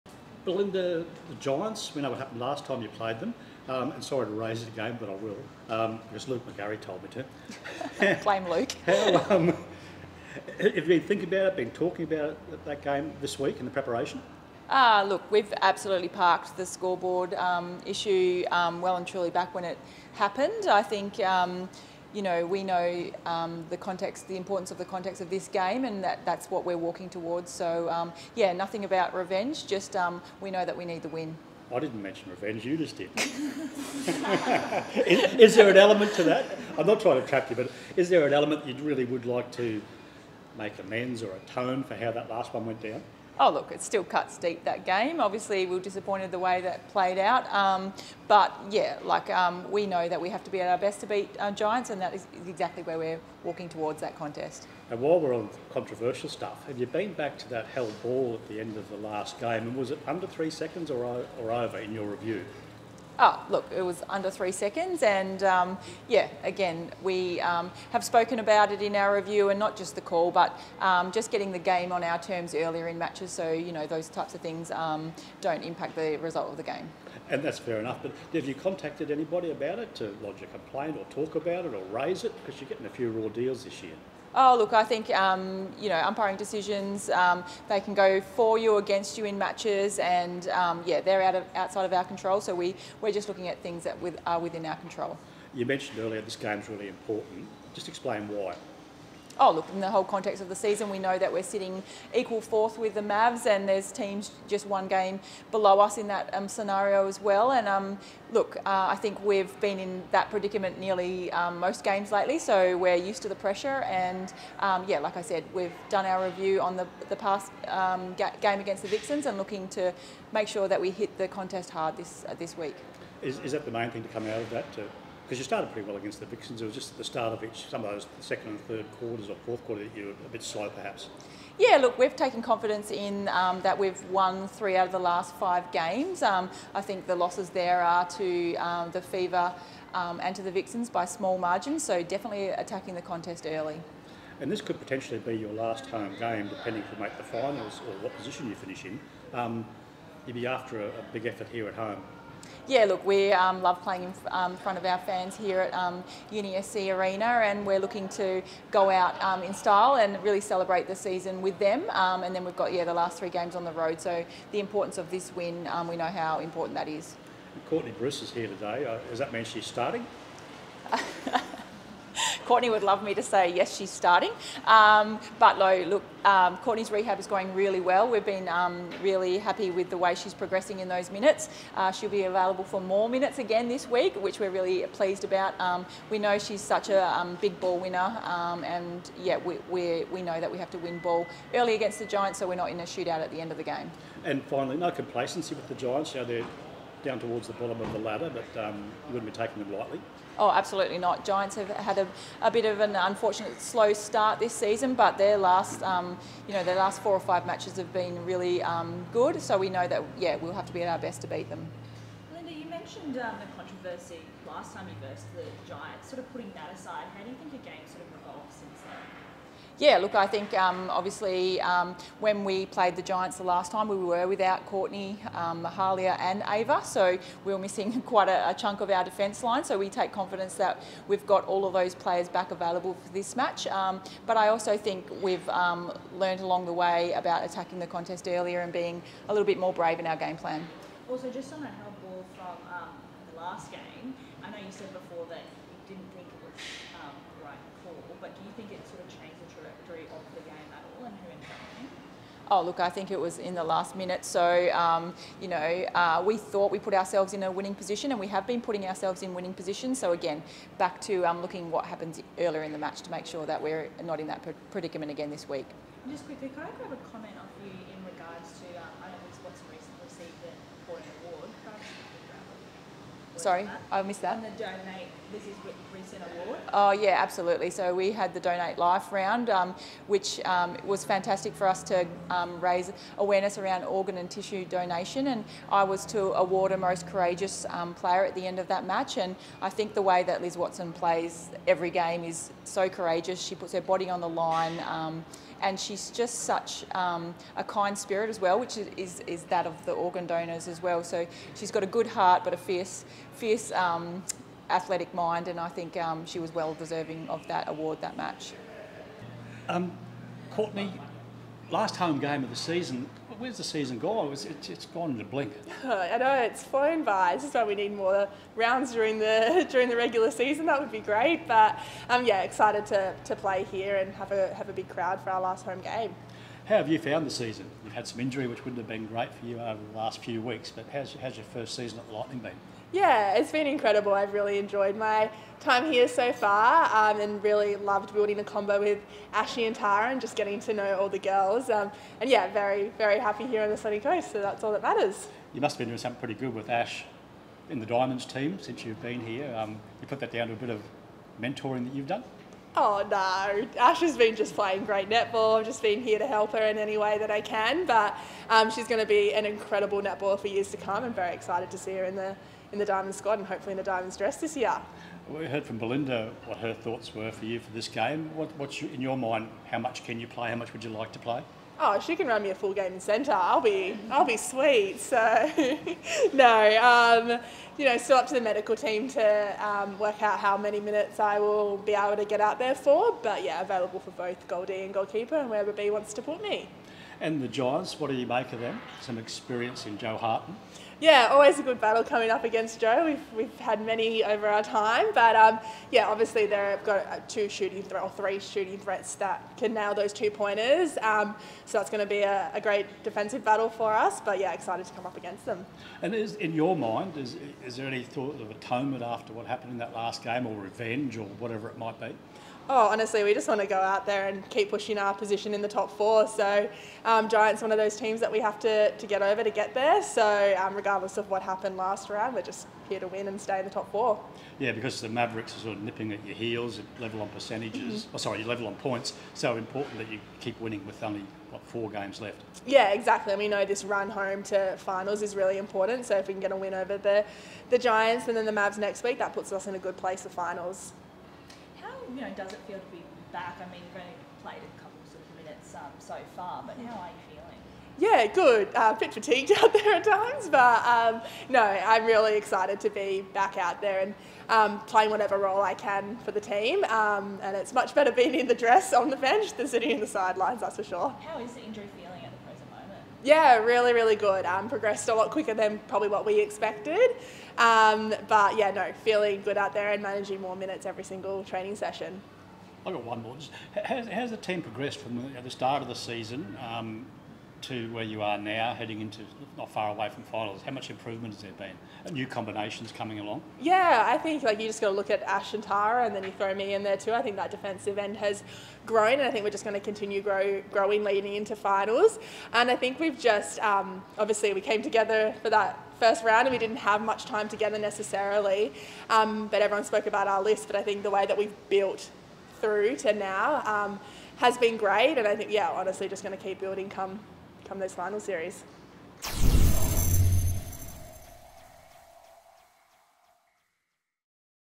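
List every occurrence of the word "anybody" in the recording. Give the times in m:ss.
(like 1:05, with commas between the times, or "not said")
1:19.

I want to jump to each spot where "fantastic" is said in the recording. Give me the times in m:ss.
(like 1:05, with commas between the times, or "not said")
4:41.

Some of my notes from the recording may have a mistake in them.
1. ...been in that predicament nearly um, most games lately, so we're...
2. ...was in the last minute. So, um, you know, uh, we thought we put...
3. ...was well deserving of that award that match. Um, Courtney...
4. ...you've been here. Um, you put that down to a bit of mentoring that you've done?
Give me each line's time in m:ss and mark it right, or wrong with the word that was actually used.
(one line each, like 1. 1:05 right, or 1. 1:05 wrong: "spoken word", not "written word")
1. 1:49 right
2. 4:13 right
3. 5:06 right
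4. 5:48 right.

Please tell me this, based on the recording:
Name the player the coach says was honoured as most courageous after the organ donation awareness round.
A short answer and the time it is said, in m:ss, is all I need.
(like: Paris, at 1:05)
Liz Watson, at 4:50.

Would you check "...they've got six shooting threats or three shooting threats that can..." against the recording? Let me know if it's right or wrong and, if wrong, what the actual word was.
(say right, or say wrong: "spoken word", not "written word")
wrong: "two", not "six".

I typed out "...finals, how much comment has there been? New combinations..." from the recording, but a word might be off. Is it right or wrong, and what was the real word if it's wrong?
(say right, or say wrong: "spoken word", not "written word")
wrong: "improvement", not "comment".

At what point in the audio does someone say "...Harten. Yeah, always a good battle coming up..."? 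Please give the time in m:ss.
6:30.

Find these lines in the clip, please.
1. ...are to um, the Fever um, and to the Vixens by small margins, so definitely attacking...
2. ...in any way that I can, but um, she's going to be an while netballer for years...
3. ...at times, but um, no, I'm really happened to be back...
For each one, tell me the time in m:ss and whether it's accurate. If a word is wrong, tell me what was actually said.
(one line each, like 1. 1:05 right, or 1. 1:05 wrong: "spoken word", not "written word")
1. 2:17 right
2. 5:56 wrong: "incredible", not "while"
3. 7:29 wrong: "excited", not "happened".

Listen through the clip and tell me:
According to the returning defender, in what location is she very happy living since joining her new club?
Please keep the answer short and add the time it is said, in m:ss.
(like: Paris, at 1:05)
the sunny coast, at 5:43.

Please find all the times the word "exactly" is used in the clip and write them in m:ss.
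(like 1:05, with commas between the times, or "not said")
0:52, 7:12.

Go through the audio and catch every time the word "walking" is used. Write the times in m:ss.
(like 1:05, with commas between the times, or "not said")
0:26, 0:53.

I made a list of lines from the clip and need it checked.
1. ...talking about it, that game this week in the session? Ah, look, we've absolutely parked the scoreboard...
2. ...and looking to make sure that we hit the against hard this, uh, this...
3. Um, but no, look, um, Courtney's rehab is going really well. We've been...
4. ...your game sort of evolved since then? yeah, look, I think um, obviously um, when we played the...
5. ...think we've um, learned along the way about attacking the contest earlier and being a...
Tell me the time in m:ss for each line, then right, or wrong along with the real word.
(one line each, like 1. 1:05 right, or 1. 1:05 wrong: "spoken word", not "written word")
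1. 0:11 wrong: "preparation", not "session"
2. 1:59 wrong: "contest", not "against"
3. 2:54 right
4. 3:37 right
5. 3:54 right.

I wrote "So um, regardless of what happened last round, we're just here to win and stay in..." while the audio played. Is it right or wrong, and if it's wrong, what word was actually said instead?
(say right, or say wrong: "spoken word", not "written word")
right.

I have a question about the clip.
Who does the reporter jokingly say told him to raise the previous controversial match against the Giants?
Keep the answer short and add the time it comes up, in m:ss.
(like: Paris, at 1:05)
Luke McGarry, at 0:06.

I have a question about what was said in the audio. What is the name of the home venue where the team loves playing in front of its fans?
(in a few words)
UniSC Arena.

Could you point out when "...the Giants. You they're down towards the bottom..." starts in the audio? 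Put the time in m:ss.
3:15.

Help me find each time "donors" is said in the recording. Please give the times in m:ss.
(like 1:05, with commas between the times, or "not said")
5:00.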